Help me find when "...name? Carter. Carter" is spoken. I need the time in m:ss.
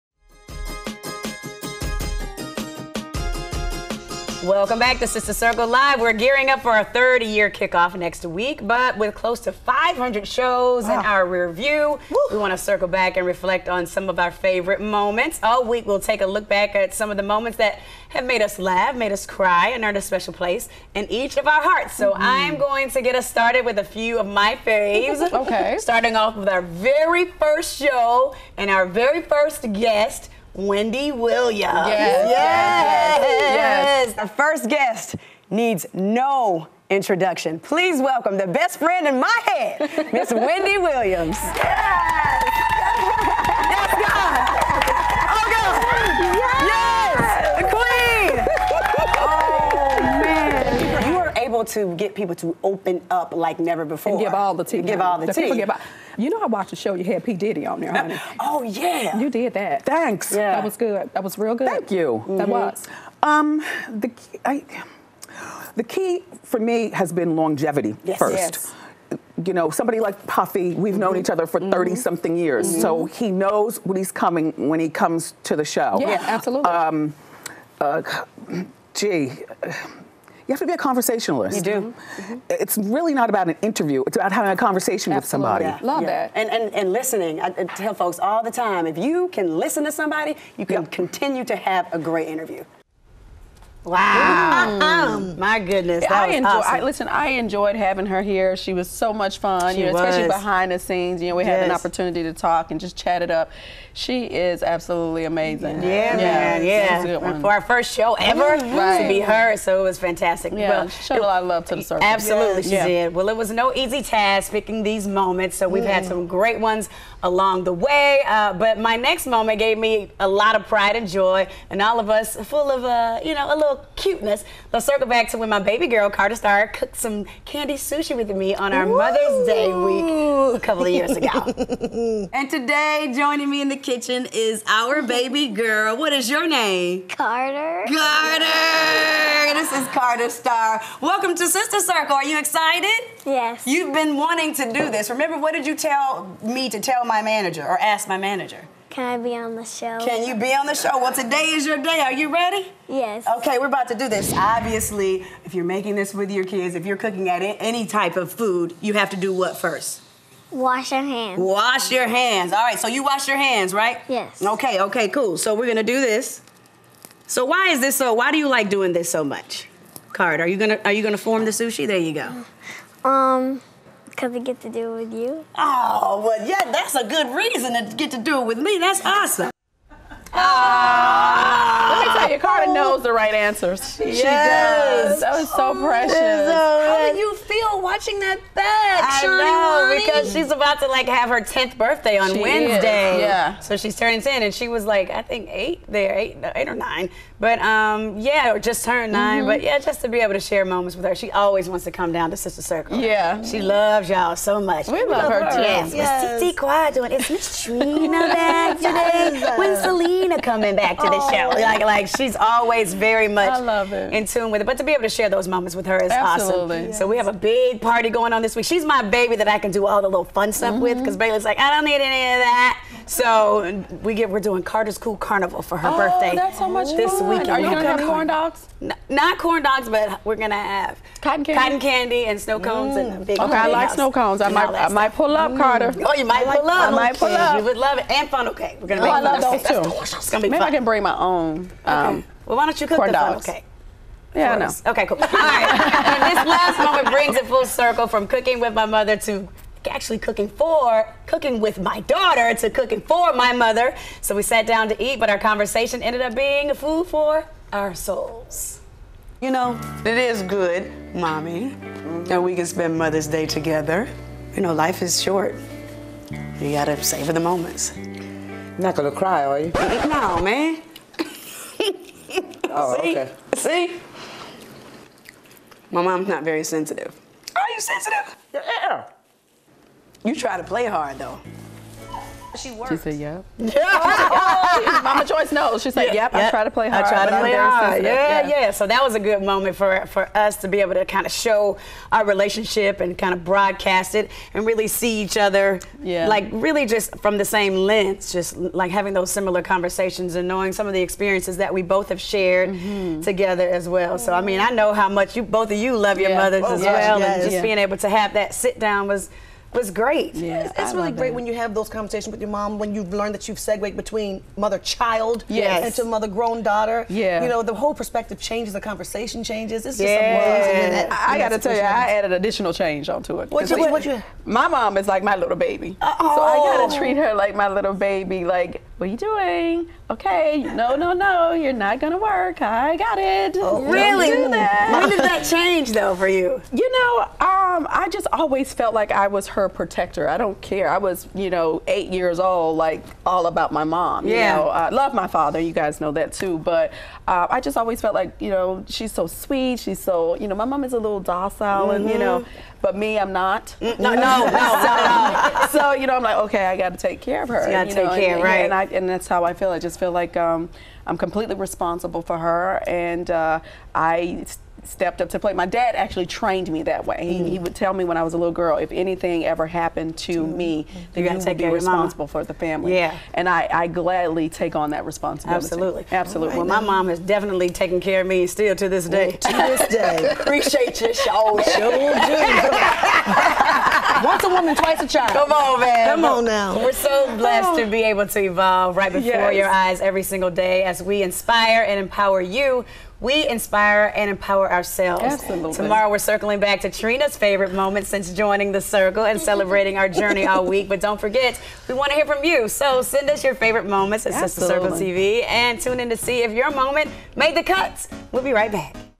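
2:16.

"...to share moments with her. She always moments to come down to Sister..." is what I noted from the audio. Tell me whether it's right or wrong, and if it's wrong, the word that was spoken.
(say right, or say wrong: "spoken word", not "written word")
wrong: "wants", not "moments".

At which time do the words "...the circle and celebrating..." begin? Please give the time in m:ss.
6:38.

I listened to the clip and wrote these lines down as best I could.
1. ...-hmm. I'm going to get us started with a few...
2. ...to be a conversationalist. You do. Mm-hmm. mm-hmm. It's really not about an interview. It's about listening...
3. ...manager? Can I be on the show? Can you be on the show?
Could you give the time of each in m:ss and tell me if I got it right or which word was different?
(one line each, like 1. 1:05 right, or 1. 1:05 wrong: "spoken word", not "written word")
1. 0:22 right
2. 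1:20 wrong: "having", not "listening"
3. 2:28 right.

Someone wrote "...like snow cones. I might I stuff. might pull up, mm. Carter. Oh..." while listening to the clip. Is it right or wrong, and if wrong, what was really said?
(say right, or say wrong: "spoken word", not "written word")
right.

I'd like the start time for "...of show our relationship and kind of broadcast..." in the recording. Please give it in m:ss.
4:51.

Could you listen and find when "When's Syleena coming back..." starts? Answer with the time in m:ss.
3:29.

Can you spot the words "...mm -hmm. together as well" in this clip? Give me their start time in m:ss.
5:02.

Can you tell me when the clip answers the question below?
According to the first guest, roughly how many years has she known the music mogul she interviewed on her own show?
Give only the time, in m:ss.
1:11.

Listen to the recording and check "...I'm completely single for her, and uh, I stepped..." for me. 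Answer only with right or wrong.
wrong.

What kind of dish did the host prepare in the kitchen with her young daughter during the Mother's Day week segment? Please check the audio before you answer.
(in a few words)
candy sushi.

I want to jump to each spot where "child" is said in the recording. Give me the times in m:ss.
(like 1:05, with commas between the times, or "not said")
5:14, 6:25.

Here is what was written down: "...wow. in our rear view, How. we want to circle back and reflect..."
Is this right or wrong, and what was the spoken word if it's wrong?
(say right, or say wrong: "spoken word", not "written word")
wrong: "Woo", not "How".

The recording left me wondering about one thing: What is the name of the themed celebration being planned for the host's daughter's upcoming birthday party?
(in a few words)
Carter's Cool Carnival.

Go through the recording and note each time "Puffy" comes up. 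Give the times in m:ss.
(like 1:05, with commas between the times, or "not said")
1:10.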